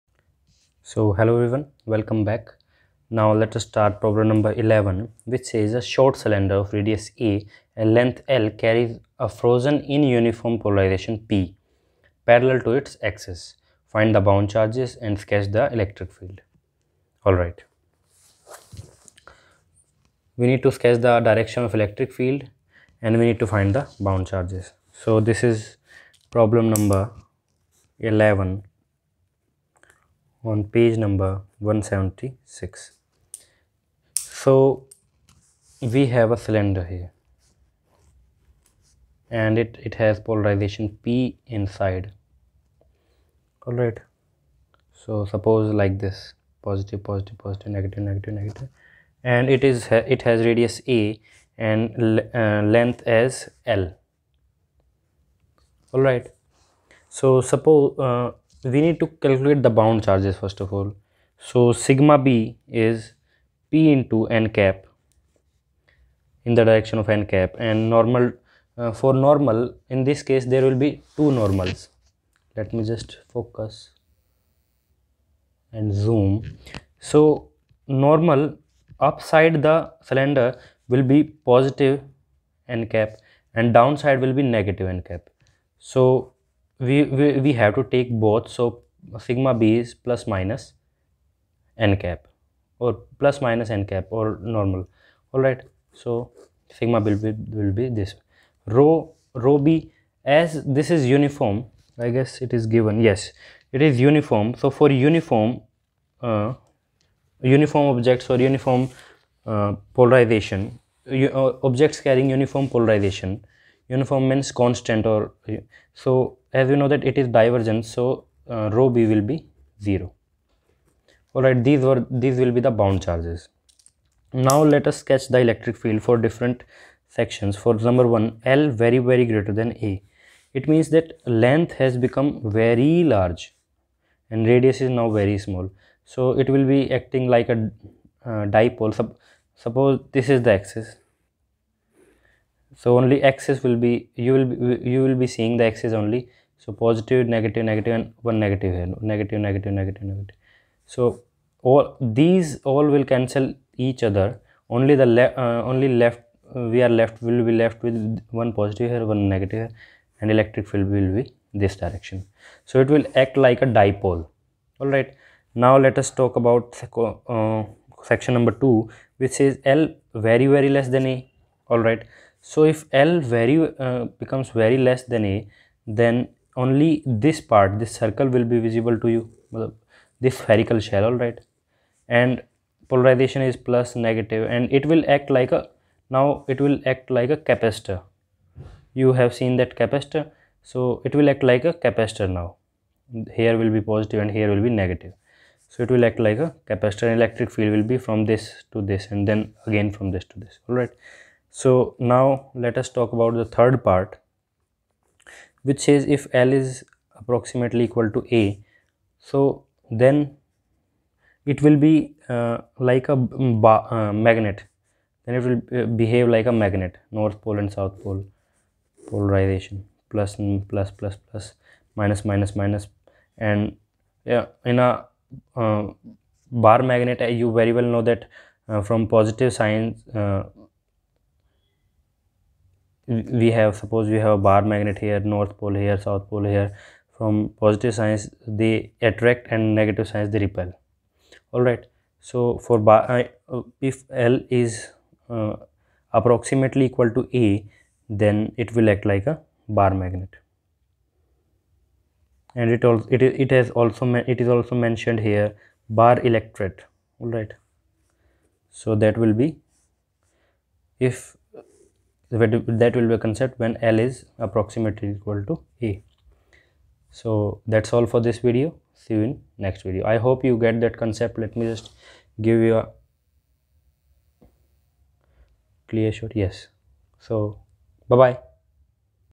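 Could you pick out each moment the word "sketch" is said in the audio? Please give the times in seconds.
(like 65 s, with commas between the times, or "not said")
15 s, 20 s, 125 s.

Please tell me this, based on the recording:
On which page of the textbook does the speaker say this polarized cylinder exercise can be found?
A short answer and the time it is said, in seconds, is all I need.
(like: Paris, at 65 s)
176, at 31 s.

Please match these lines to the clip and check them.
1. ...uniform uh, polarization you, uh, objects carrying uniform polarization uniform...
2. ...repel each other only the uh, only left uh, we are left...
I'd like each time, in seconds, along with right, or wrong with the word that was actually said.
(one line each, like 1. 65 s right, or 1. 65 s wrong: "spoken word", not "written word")
1. 108 s right
2. 153 s wrong: "cancel", not "repel".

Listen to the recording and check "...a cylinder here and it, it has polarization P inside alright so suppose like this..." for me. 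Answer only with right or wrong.
right.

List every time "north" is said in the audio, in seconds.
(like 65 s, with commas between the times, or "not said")
217 s, 235 s.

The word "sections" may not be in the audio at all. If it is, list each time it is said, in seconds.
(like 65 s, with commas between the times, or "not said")
127 s, 168 s.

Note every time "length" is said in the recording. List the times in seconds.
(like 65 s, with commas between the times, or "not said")
7 s, 52 s, 131 s.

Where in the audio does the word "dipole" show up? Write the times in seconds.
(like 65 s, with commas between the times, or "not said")
138 s, 163 s.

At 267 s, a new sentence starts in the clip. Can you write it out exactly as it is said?
So that's all for this video.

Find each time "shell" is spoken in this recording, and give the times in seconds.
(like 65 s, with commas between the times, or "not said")
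180 s.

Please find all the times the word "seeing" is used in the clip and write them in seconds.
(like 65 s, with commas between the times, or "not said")
145 s.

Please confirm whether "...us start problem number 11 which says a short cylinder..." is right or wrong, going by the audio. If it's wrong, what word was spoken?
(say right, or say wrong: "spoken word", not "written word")
right.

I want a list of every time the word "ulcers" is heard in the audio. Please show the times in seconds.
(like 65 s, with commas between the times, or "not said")
not said.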